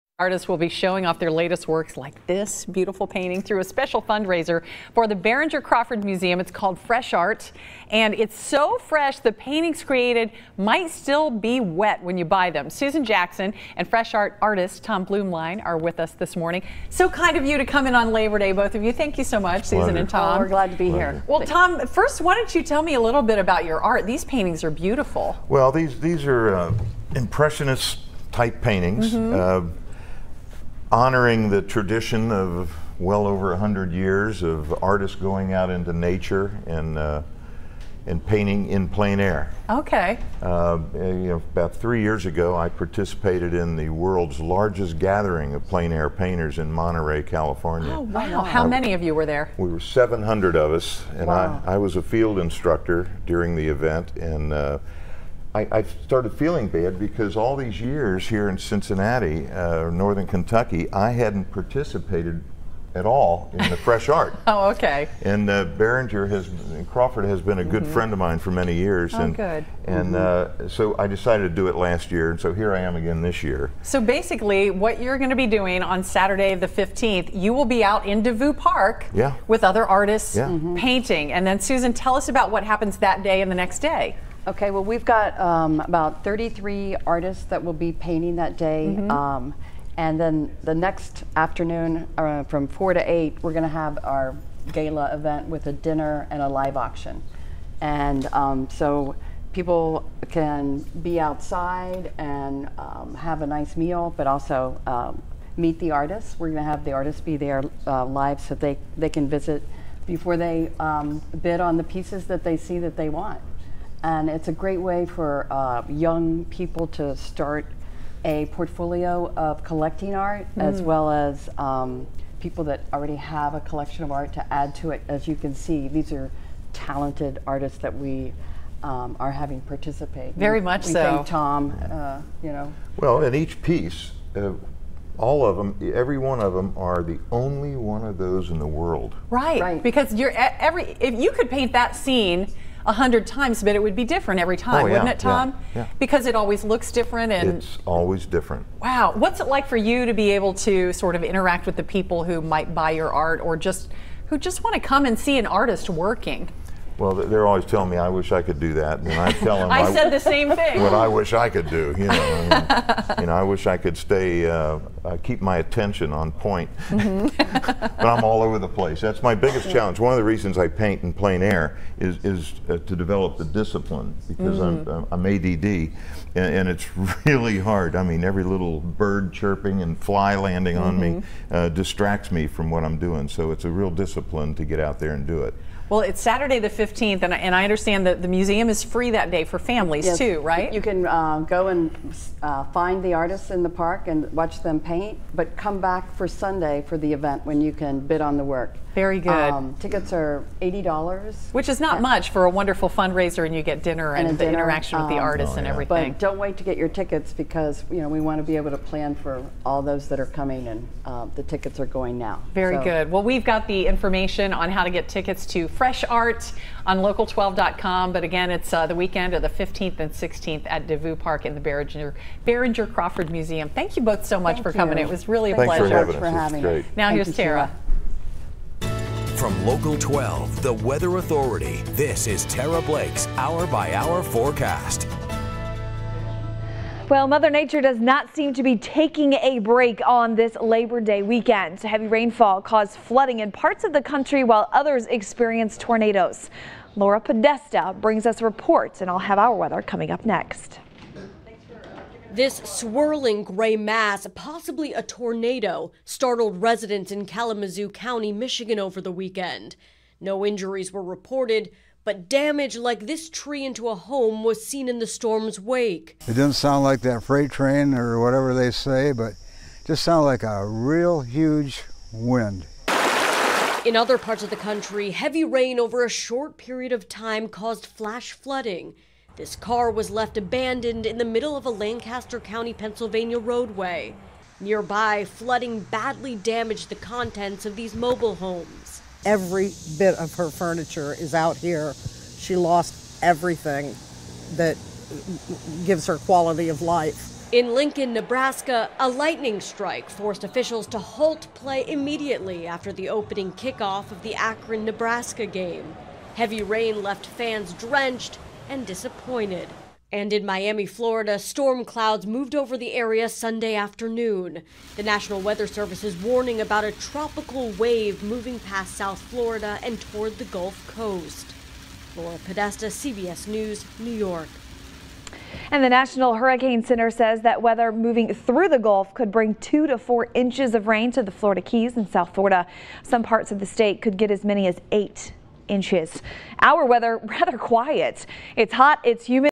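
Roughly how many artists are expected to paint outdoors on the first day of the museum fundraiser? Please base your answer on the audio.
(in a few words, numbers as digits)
33.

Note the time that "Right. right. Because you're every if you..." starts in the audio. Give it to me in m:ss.
2:19.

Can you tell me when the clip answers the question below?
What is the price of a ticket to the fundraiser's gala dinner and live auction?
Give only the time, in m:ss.
3:20.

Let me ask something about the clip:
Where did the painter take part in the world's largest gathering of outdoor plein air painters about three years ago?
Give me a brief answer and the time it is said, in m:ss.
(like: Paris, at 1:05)
Monterey, California, at 0:46.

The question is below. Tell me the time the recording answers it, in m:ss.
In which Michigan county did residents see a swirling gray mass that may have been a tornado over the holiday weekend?
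4:17.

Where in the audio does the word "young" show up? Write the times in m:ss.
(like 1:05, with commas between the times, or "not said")
1:55.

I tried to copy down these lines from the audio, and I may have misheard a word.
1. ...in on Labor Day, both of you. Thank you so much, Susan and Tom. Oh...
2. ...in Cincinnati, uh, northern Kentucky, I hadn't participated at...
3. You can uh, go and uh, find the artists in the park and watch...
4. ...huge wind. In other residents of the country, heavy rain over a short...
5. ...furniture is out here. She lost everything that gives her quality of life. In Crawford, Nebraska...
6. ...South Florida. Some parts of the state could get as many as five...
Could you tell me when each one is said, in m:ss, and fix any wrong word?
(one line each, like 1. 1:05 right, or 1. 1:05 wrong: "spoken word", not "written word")
1. 0:17 right
2. 0:58 right
3. 3:10 right
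4. 4:31 wrong: "parts", not "residents"
5. 4:50 wrong: "Lincoln", not "Crawford"
6. 5:32 wrong: "eight", not "five".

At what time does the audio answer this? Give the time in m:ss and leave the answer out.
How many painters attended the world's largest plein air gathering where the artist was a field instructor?
0:49.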